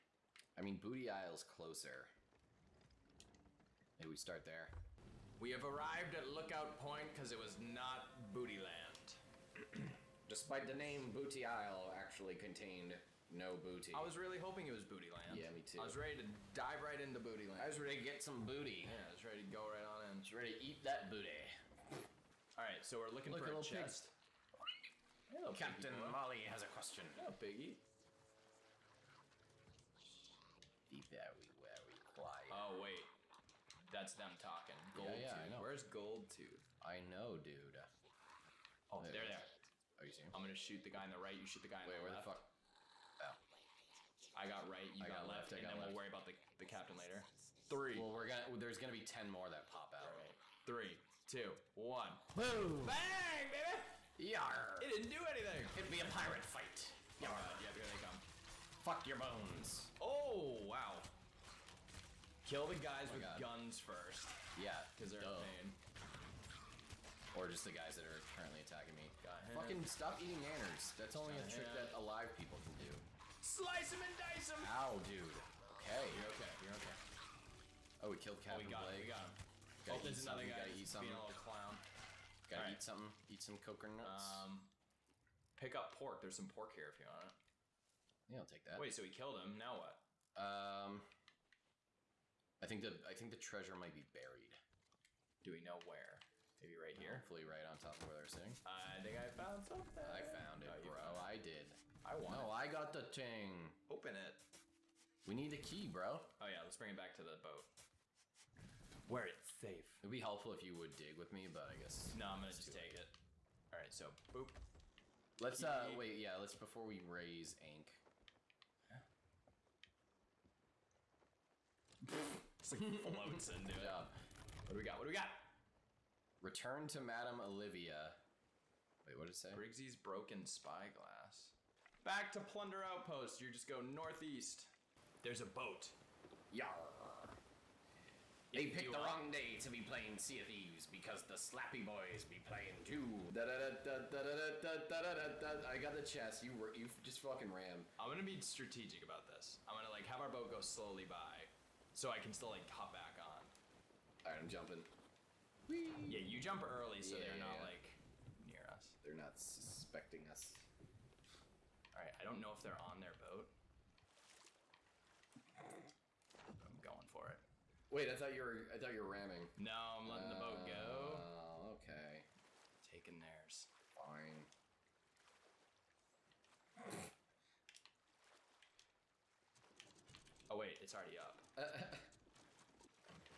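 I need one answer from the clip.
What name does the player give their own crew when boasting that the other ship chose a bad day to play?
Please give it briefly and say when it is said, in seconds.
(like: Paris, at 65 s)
Slappy Boiz, at 141 s.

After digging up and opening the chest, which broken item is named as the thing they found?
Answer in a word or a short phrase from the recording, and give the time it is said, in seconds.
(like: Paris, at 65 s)
Briggsy's broken spyglass, at 129 s.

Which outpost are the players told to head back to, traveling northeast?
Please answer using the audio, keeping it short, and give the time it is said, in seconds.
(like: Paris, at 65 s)
Plunder Outpost, at 132 s.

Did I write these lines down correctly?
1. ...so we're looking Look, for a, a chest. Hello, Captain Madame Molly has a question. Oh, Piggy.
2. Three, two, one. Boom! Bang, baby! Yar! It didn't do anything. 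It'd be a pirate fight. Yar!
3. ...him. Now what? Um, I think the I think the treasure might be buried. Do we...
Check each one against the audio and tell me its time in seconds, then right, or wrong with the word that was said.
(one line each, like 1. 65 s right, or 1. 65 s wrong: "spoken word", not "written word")
1. 22 s wrong: "Piggy", not "Madame"
2. 50 s right
3. 89 s right.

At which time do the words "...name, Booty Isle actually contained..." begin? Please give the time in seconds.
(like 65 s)
10 s.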